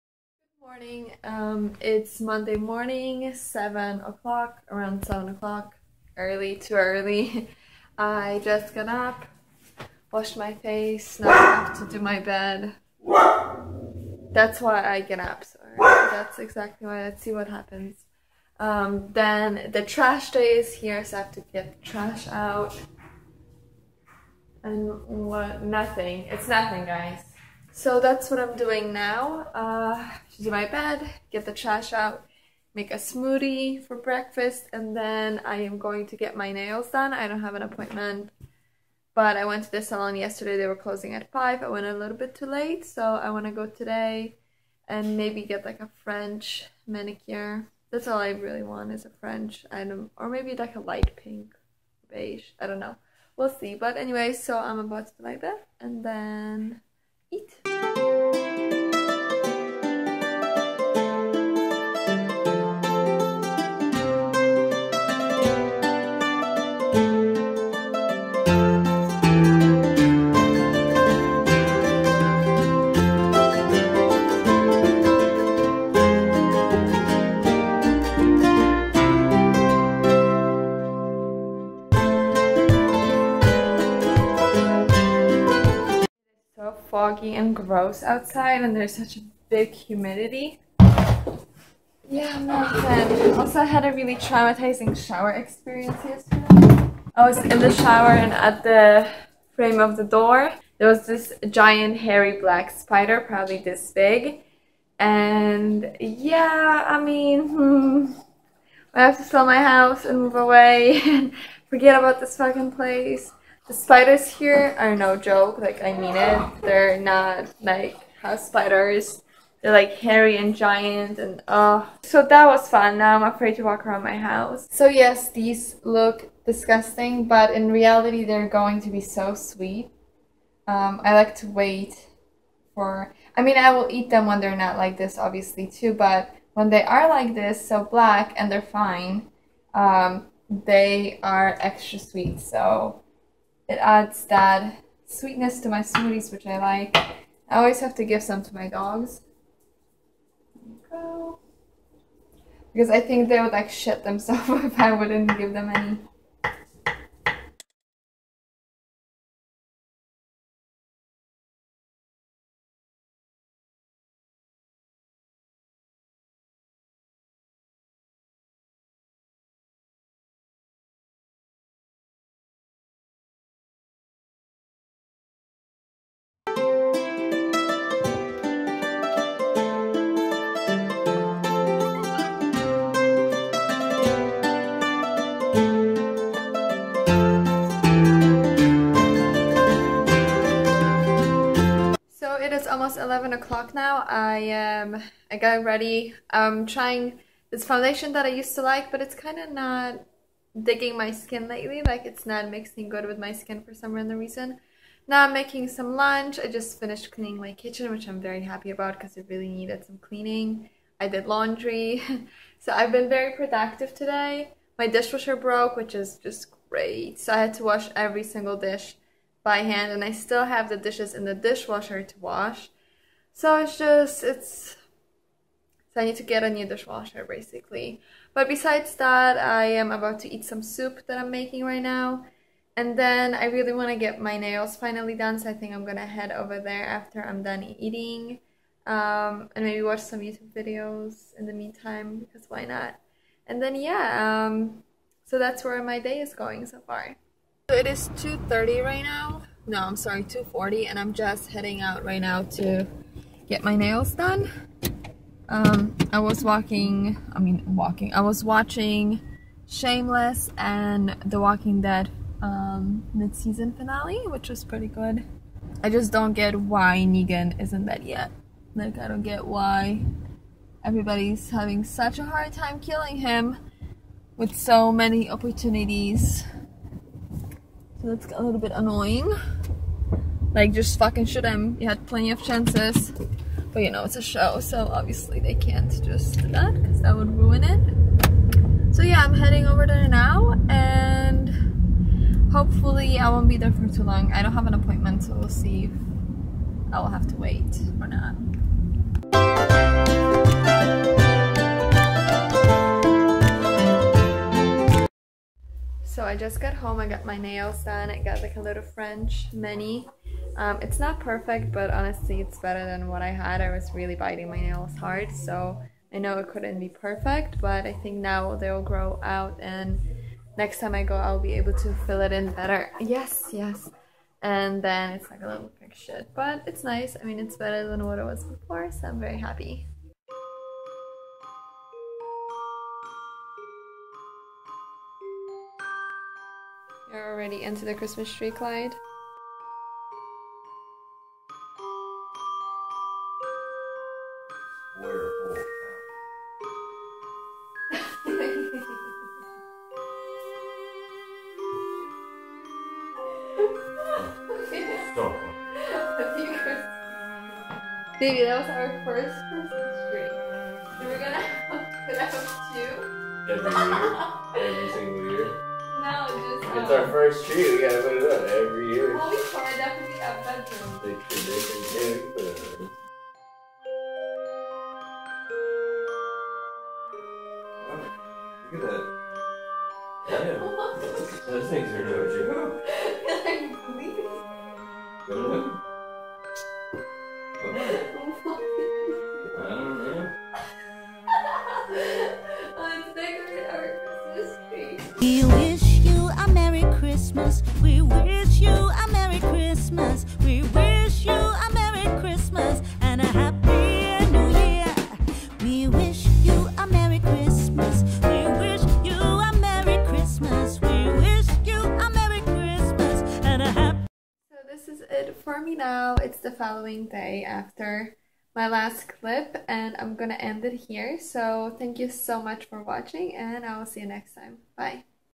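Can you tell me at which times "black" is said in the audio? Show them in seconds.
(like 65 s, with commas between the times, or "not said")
102 s, 137 s.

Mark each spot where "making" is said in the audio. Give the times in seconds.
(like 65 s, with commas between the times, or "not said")
205 s, 231 s.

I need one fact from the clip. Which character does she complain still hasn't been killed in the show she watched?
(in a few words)
Negan.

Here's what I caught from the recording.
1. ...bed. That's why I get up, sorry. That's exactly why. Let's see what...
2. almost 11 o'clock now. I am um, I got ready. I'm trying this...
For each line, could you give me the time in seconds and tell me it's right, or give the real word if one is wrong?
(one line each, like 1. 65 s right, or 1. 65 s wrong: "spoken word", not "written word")
1. 12 s right
2. 192 s right.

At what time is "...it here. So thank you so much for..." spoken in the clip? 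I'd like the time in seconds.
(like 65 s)
420 s.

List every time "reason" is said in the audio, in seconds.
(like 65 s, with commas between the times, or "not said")
204 s.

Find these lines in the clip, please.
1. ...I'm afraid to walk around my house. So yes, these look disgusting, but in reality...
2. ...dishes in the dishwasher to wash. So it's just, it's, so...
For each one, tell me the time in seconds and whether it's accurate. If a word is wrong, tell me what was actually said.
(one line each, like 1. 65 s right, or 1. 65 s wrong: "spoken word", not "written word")
1. 123 s right
2. 220 s right.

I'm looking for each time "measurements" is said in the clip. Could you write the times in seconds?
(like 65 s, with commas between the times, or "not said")
not said.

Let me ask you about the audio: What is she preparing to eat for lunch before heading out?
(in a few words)
Soup.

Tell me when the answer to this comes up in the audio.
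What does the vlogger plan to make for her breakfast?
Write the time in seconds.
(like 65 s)
32 s.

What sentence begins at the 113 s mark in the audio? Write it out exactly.
The spiders here are no joke.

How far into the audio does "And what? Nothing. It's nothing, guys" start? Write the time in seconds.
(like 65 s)
24 s.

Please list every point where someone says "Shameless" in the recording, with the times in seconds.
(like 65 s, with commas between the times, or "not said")
259 s.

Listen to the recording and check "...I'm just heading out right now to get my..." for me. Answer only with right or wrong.
right.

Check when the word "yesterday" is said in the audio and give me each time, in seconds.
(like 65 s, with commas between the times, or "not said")
40 s, 96 s.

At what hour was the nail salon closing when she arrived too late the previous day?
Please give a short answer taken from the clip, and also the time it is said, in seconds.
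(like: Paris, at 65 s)
5, at 41 s.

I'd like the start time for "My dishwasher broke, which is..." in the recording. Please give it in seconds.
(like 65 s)
214 s.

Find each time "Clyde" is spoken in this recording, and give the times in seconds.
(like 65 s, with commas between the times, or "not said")
338 s.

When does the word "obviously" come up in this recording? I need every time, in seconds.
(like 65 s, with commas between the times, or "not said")
135 s, 284 s.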